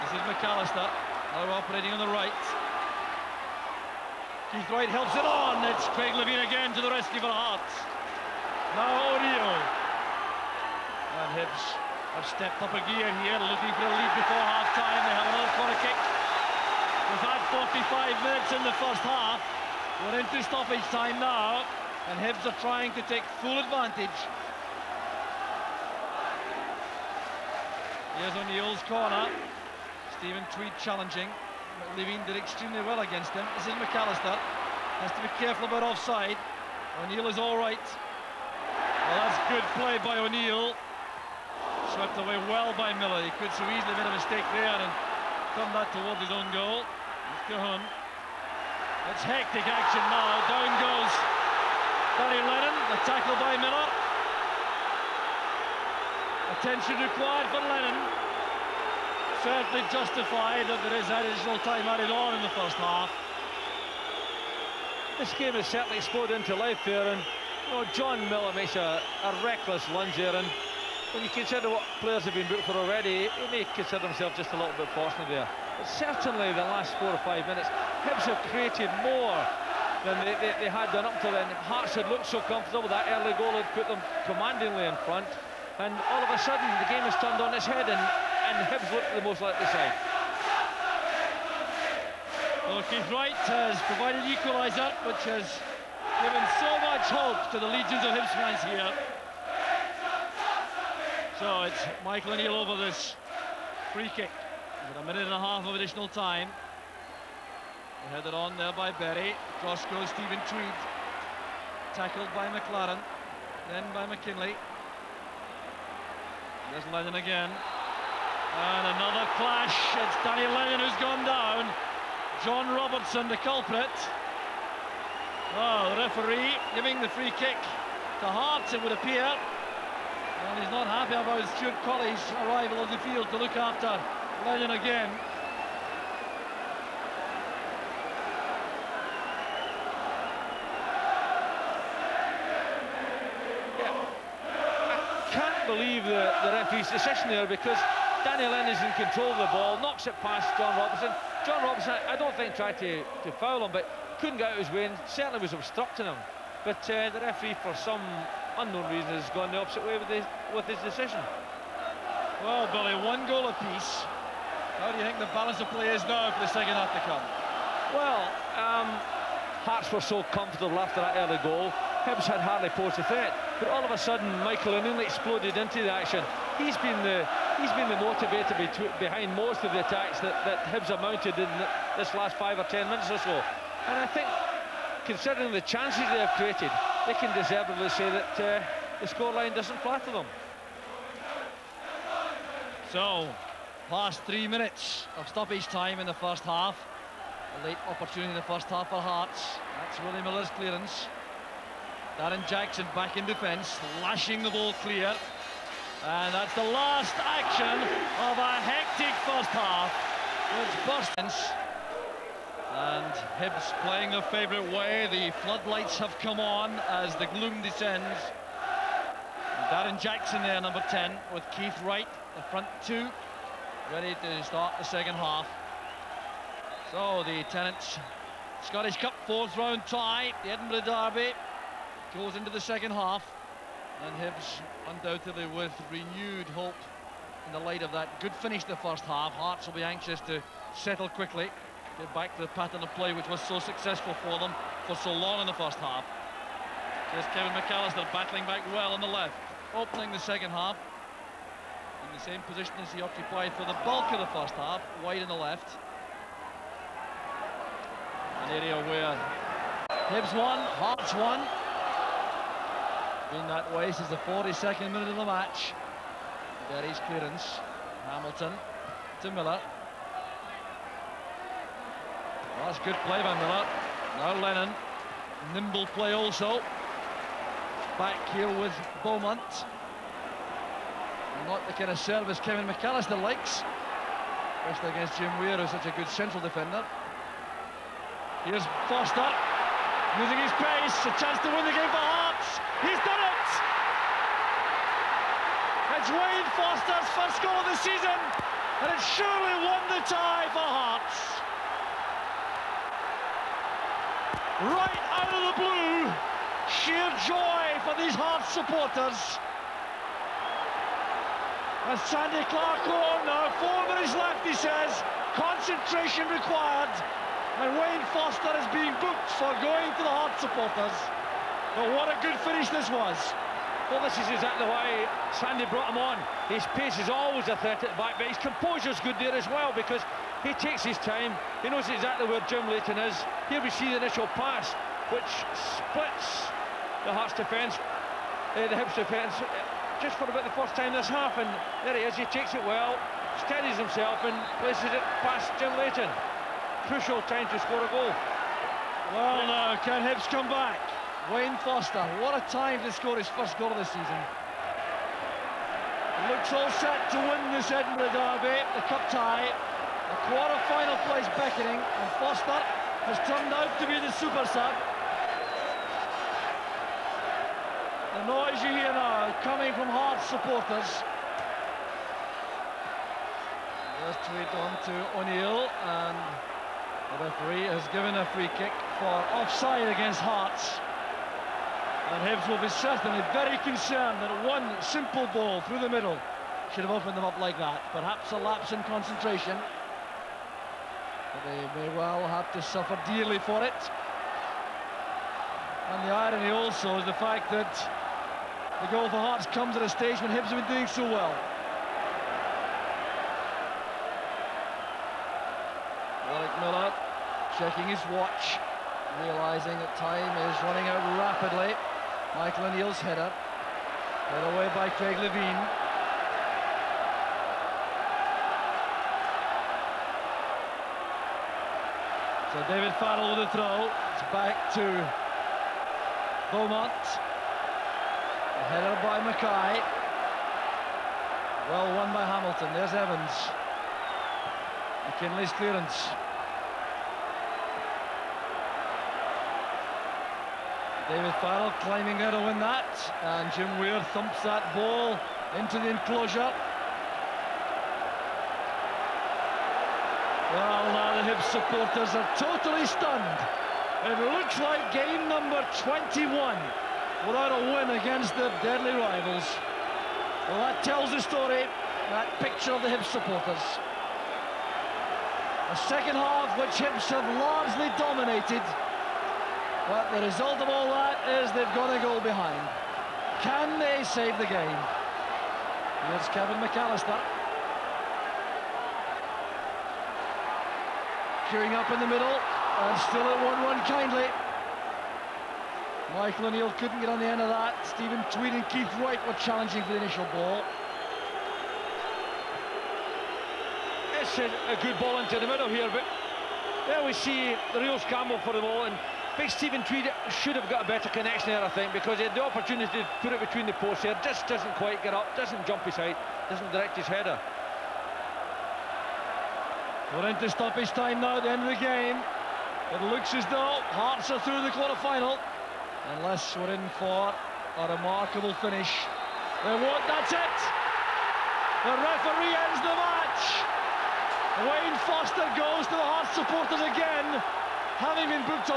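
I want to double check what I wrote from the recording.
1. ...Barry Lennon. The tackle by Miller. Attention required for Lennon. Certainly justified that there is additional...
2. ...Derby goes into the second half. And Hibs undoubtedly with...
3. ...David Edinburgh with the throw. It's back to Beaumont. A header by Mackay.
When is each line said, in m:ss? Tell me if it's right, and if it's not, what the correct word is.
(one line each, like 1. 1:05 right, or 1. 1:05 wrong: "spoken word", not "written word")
1. 0:52 right
2. 3:50 right
3. 7:02 wrong: "Farrell", not "Edinburgh".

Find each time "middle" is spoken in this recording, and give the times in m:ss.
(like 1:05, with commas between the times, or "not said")
6:25, 8:02, 8:15.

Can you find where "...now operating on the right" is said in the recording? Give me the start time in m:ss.
0:01.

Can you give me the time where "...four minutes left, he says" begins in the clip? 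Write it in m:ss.
5:13.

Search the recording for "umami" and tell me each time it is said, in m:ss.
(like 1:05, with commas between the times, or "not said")
not said.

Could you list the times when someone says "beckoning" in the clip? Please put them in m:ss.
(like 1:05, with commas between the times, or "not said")
6:01.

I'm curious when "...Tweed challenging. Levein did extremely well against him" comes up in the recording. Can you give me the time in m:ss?
0:30.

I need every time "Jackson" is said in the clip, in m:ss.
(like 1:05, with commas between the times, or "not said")
3:22, 3:39.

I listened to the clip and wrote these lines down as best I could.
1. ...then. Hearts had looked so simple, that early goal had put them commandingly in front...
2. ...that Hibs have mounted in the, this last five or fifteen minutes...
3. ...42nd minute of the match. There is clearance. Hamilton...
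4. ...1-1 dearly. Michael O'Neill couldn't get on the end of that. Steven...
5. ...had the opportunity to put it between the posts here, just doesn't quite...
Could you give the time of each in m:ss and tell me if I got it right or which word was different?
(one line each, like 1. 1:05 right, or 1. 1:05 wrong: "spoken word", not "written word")
1. 1:21 wrong: "comfortable", not "simple"
2. 3:00 wrong: "ten", not "fifteen"
3. 4:24 right
4. 8:03 wrong: "kindly", not "dearly"
5. 8:22 right.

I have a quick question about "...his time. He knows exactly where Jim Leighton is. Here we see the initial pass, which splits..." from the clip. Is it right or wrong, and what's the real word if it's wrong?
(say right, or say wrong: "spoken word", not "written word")
right.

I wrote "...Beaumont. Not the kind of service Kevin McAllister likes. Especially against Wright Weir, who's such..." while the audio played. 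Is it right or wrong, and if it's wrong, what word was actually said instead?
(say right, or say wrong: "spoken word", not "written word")
wrong: "Jim", not "Wright".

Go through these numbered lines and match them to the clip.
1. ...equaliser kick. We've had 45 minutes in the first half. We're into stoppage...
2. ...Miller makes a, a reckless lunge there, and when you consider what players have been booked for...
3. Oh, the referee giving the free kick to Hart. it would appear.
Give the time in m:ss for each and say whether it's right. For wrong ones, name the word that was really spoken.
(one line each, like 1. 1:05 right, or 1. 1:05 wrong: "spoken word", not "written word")
1. 0:15 wrong: "corner", not "equaliser"
2. 1:08 right
3. 2:05 right.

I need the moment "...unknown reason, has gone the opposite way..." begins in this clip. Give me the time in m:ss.
2:38.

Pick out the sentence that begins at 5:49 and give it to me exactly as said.
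Well, now, can Hibs come back?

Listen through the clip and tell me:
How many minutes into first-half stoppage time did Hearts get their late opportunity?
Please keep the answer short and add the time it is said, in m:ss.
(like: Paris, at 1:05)
3, at 3:14.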